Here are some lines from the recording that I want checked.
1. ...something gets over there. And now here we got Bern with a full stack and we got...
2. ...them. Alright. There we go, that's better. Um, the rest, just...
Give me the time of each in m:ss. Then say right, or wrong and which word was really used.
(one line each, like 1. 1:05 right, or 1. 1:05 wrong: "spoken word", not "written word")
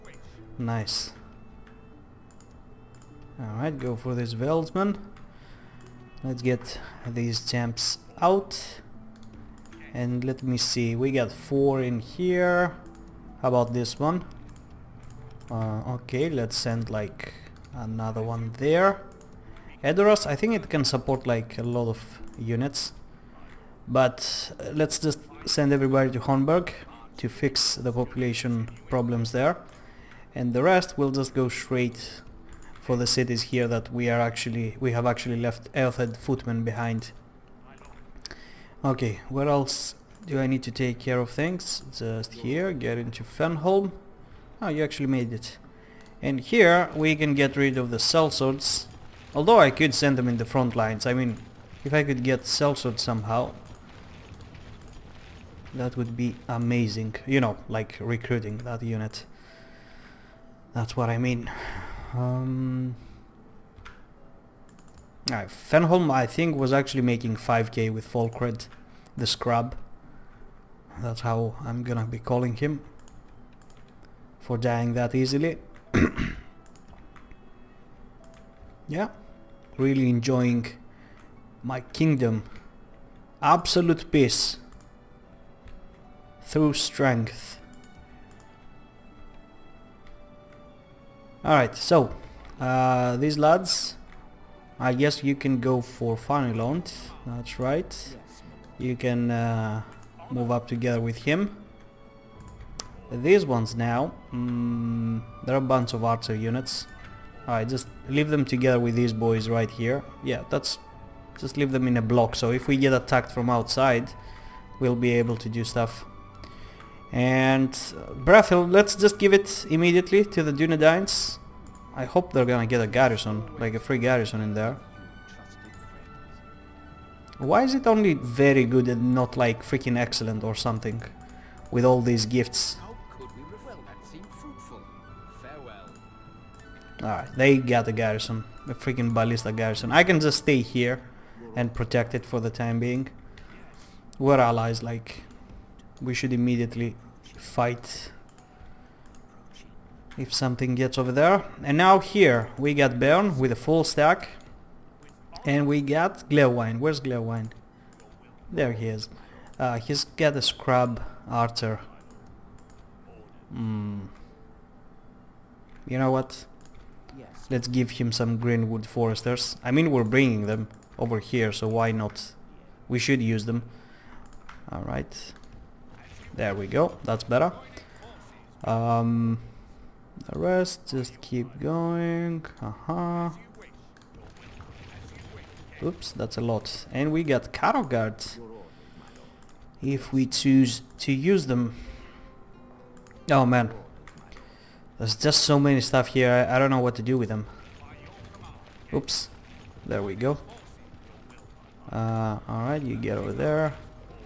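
1. 2:30 right
2. 2:53 right.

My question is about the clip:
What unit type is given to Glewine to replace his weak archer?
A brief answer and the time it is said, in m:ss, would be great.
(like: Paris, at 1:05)
Greenwood Foresters, at 2:48.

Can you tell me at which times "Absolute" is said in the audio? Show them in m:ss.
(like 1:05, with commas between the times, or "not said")
1:23.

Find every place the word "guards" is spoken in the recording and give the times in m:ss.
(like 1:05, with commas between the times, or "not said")
3:07.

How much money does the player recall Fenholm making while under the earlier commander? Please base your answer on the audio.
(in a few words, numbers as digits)
5k.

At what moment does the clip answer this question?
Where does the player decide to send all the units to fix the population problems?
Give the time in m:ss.
0:26.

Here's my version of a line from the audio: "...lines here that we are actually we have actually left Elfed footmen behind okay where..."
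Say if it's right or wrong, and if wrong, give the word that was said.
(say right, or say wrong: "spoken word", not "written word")
wrong: "cities", not "lines".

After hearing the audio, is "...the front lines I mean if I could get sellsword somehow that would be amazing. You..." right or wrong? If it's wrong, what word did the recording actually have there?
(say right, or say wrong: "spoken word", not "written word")
right.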